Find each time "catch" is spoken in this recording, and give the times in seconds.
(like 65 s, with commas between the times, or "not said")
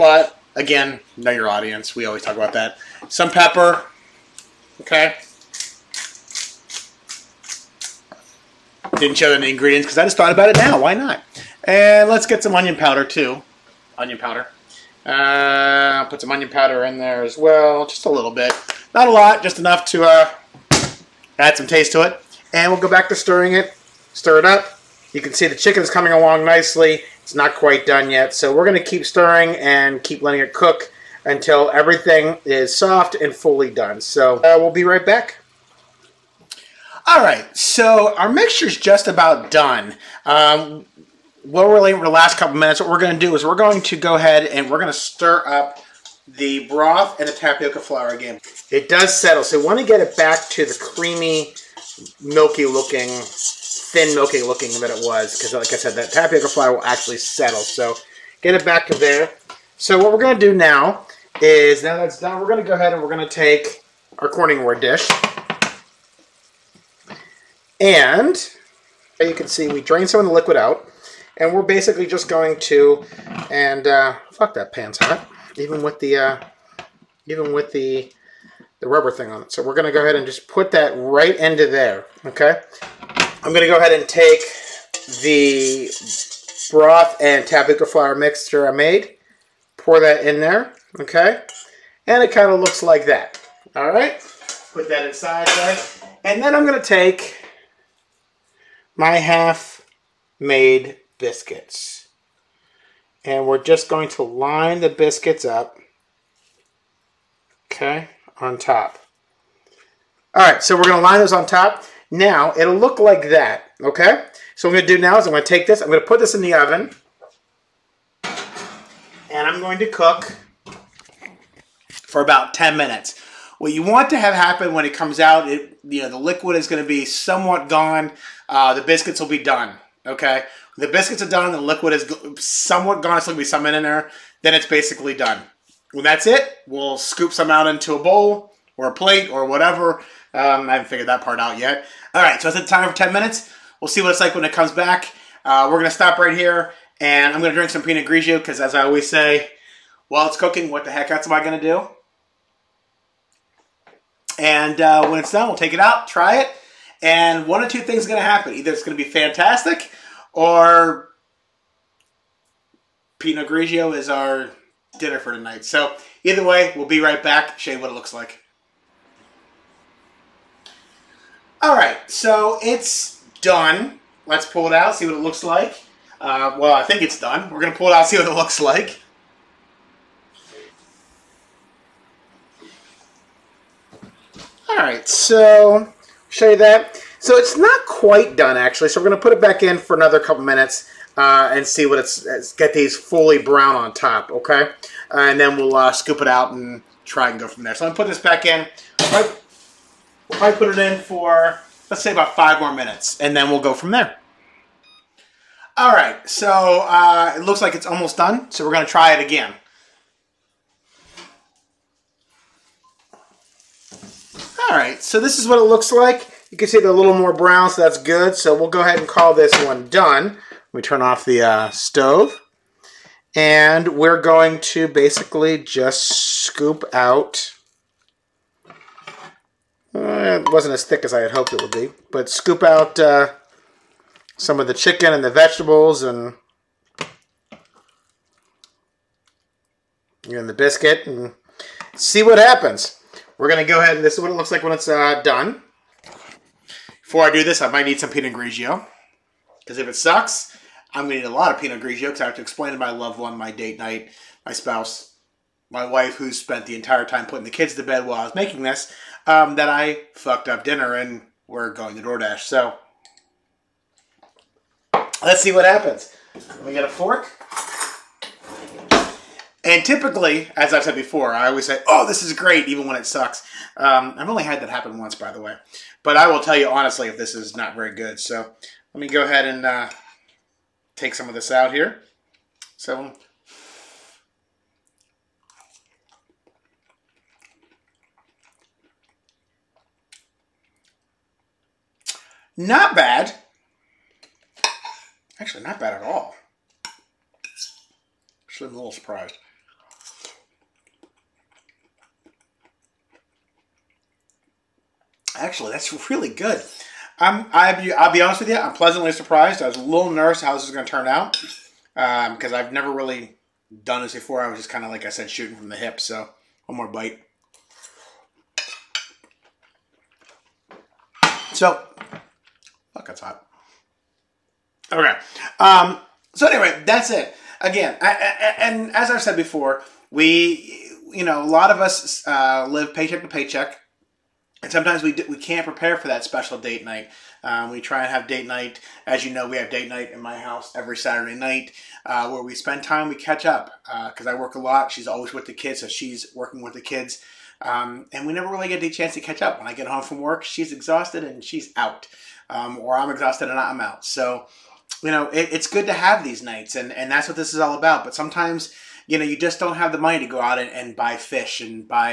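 343 s, 349 s.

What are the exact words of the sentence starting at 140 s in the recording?
Um, I haven't figured that part out yet.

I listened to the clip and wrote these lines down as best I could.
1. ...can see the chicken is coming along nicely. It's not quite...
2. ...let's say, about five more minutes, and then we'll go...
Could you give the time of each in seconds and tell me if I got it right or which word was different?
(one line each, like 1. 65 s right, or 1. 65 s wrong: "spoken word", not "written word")
1. 25 s right
2. 201 s right.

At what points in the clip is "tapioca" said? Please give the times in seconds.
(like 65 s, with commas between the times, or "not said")
47 s, 56 s, 87 s.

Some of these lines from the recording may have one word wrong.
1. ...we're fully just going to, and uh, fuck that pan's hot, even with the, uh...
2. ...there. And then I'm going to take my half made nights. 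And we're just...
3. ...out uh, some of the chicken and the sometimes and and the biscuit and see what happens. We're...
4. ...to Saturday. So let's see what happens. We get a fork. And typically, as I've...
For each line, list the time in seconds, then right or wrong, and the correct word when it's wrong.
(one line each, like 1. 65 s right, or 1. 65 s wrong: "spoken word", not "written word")
1. 71 s wrong: "basically", not "fully"
2. 95 s wrong: "biscuits", not "nights"
3. 232 s wrong: "vegetables", not "sometimes"
4. 261 s wrong: "DoorDash", not "Saturday".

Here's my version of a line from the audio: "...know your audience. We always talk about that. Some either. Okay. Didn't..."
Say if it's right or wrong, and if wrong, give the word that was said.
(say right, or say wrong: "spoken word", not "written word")
wrong: "pepper", not "either".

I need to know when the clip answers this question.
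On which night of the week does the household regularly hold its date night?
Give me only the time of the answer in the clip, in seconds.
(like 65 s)
340 s.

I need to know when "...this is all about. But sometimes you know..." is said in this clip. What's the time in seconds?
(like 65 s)
357 s.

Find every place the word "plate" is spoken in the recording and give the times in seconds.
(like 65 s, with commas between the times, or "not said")
138 s.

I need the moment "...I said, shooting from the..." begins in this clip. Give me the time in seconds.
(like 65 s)
315 s.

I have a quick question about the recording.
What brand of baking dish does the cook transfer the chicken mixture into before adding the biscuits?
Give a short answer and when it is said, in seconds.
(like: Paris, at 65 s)
Corningware, at 64 s.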